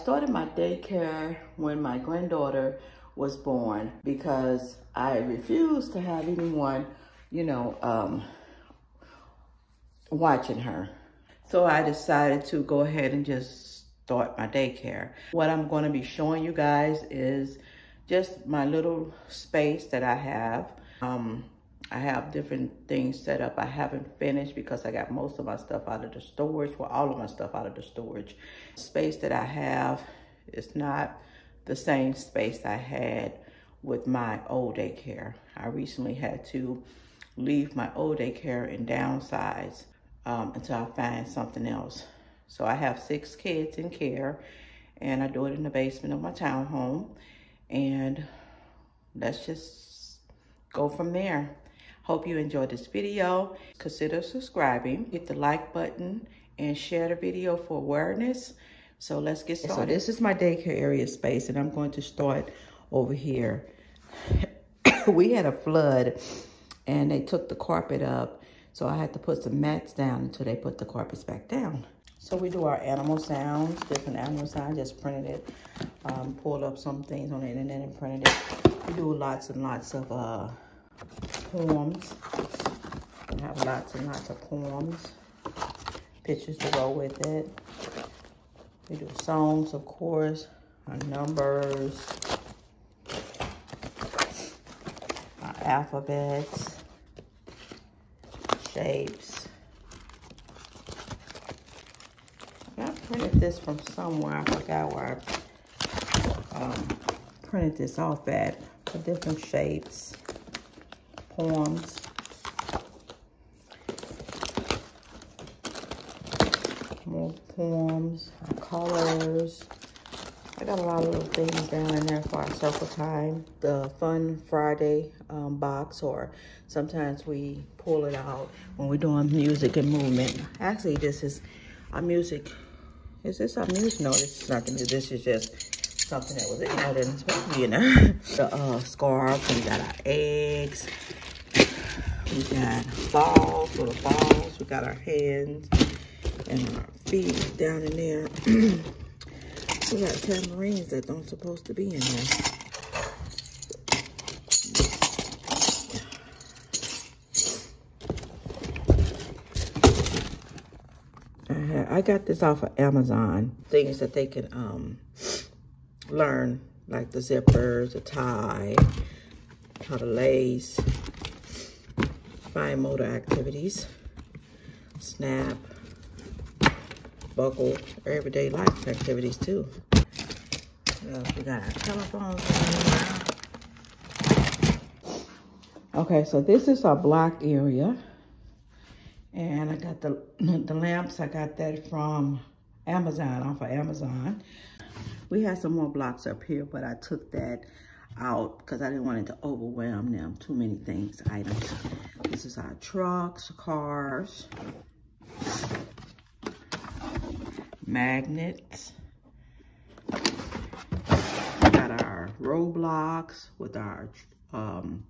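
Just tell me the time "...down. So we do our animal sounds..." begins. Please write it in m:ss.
1:11.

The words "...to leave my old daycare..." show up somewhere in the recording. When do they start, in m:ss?
0:36.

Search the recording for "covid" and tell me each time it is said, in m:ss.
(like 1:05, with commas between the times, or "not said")
not said.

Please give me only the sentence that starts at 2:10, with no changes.
Actually, this is our music is this something new?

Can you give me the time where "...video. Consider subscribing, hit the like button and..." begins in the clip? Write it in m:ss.
0:52.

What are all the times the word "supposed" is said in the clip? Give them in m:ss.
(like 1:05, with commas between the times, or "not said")
2:17, 2:31.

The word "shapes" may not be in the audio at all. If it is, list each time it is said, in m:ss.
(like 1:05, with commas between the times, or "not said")
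1:38, 1:49.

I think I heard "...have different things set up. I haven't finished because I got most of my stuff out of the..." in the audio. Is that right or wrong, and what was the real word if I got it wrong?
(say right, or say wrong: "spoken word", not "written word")
right.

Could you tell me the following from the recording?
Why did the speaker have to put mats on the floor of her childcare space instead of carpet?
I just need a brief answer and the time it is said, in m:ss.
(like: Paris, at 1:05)
a flood, at 1:05.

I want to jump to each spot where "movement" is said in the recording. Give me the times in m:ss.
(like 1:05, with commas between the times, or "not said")
2:09.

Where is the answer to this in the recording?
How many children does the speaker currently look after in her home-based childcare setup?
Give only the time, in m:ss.
0:43.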